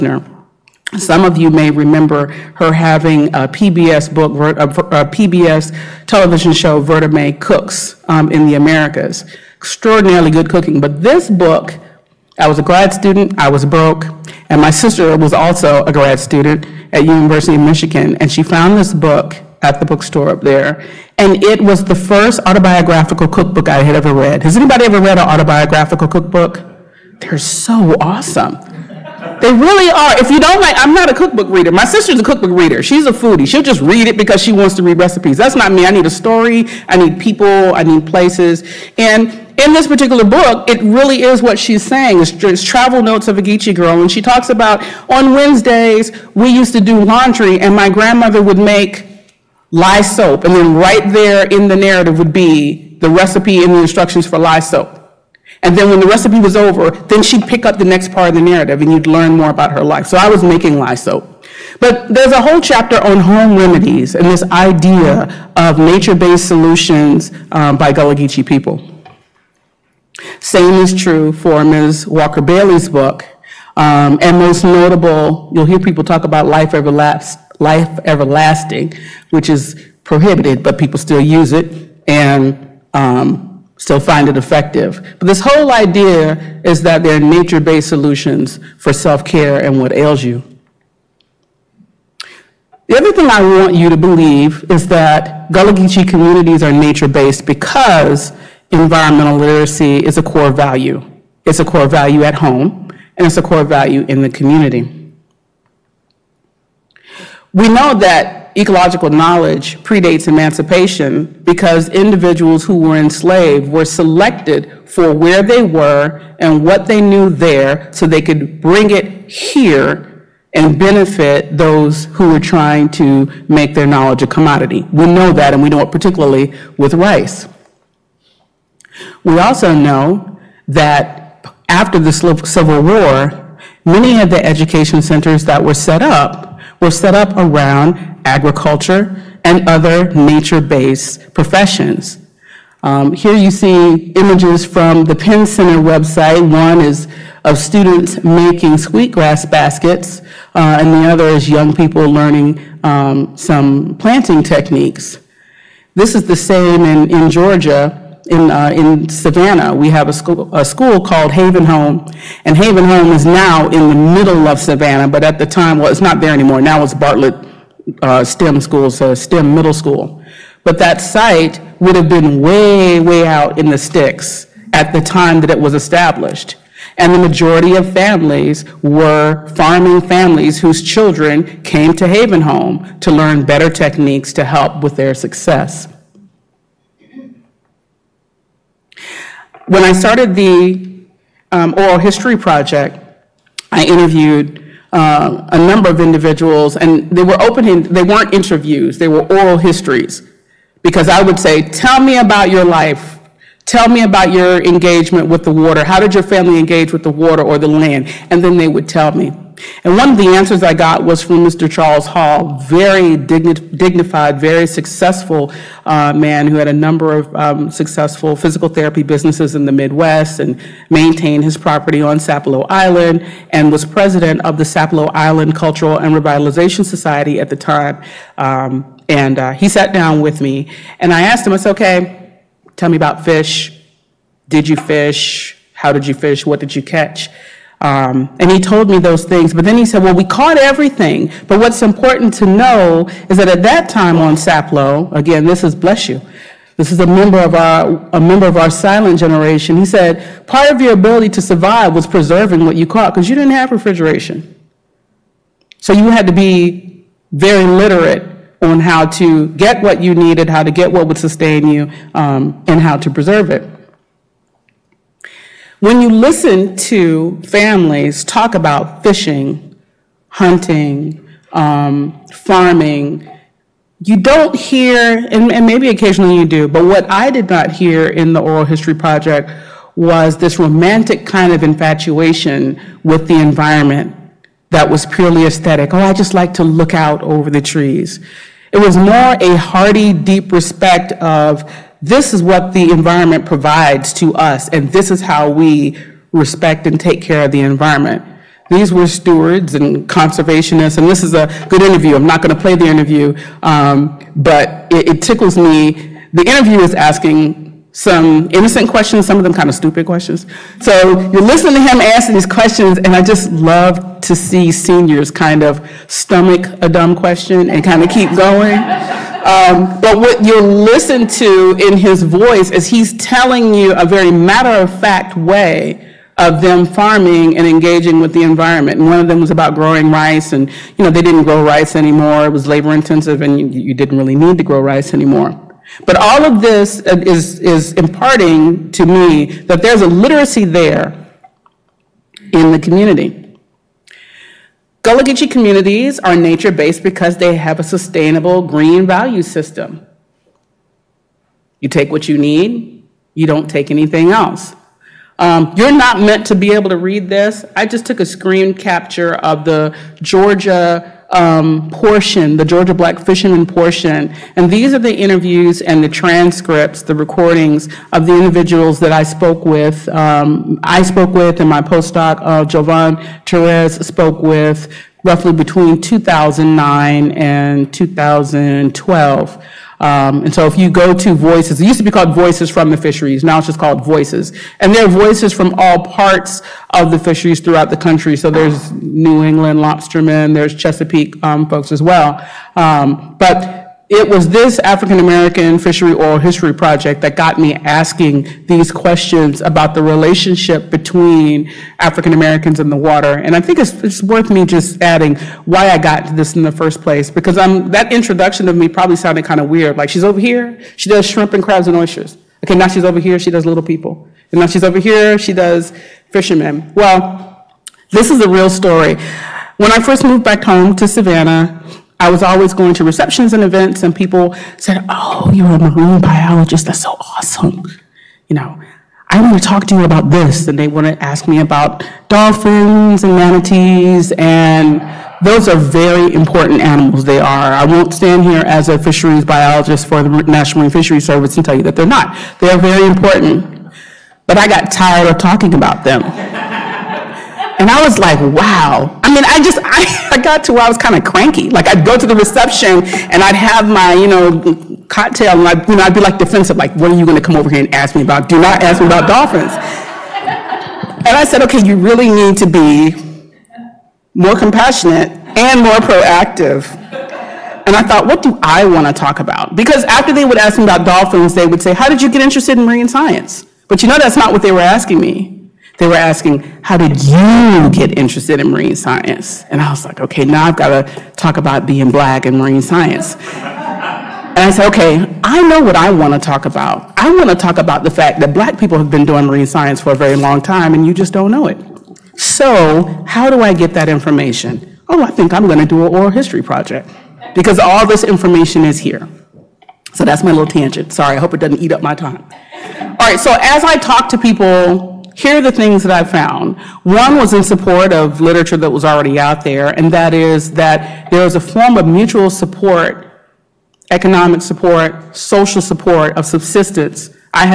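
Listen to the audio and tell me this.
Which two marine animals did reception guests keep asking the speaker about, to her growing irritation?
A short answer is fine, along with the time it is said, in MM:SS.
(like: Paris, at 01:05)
Dolphins and manatees, at 07:12.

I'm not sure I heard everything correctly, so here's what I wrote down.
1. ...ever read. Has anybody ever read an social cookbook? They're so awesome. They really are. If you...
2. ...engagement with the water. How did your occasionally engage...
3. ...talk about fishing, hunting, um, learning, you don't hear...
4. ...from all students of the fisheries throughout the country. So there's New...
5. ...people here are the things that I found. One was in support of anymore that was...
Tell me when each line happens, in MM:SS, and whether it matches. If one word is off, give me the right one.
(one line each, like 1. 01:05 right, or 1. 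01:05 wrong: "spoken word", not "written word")
1. 00:23 wrong: "autobiographical", not "social"
2. 03:24 wrong: "family", not "occasionally"
3. 04:28 wrong: "farming", not "learning"
4. 06:25 wrong: "parts", not "students"
5. 08:24 wrong: "literature", not "anymore".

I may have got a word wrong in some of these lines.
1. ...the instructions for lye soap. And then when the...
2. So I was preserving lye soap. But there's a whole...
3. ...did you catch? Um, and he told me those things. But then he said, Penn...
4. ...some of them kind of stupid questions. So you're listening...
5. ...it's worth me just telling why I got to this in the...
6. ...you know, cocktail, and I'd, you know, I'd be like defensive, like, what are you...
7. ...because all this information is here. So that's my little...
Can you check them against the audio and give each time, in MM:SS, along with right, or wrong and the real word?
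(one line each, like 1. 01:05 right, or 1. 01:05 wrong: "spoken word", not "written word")
1. 00:53 right
2. 01:00 wrong: "making", not "preserving"
3. 03:56 wrong: "Well", not "Penn"
4. 05:09 right
5. 06:44 wrong: "adding", not "telling"
6. 07:34 right
7. 08:17 right.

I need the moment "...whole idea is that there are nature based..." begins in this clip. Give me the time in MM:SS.
01:25.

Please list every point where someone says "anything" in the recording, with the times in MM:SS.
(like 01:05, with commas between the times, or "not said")
05:53.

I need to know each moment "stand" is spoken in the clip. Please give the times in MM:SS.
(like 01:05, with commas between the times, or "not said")
07:18.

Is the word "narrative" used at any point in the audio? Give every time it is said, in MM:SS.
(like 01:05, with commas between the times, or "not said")
00:51, 00:58.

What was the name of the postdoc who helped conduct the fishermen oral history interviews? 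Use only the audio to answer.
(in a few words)
Jovan Torres.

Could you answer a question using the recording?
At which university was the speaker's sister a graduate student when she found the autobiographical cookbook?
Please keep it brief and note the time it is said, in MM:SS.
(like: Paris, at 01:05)
University of Michigan, at 00:17.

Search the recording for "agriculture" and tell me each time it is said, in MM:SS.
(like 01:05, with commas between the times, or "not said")
02:18.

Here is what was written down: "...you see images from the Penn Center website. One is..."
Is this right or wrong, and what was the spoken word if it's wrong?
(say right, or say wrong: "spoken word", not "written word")
right.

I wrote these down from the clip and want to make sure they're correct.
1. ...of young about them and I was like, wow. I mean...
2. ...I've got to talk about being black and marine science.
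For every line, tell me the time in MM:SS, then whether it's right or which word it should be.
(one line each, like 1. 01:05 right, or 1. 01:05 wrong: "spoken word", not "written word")
1. 07:25 wrong: "talking", not "young"
2. 08:00 right.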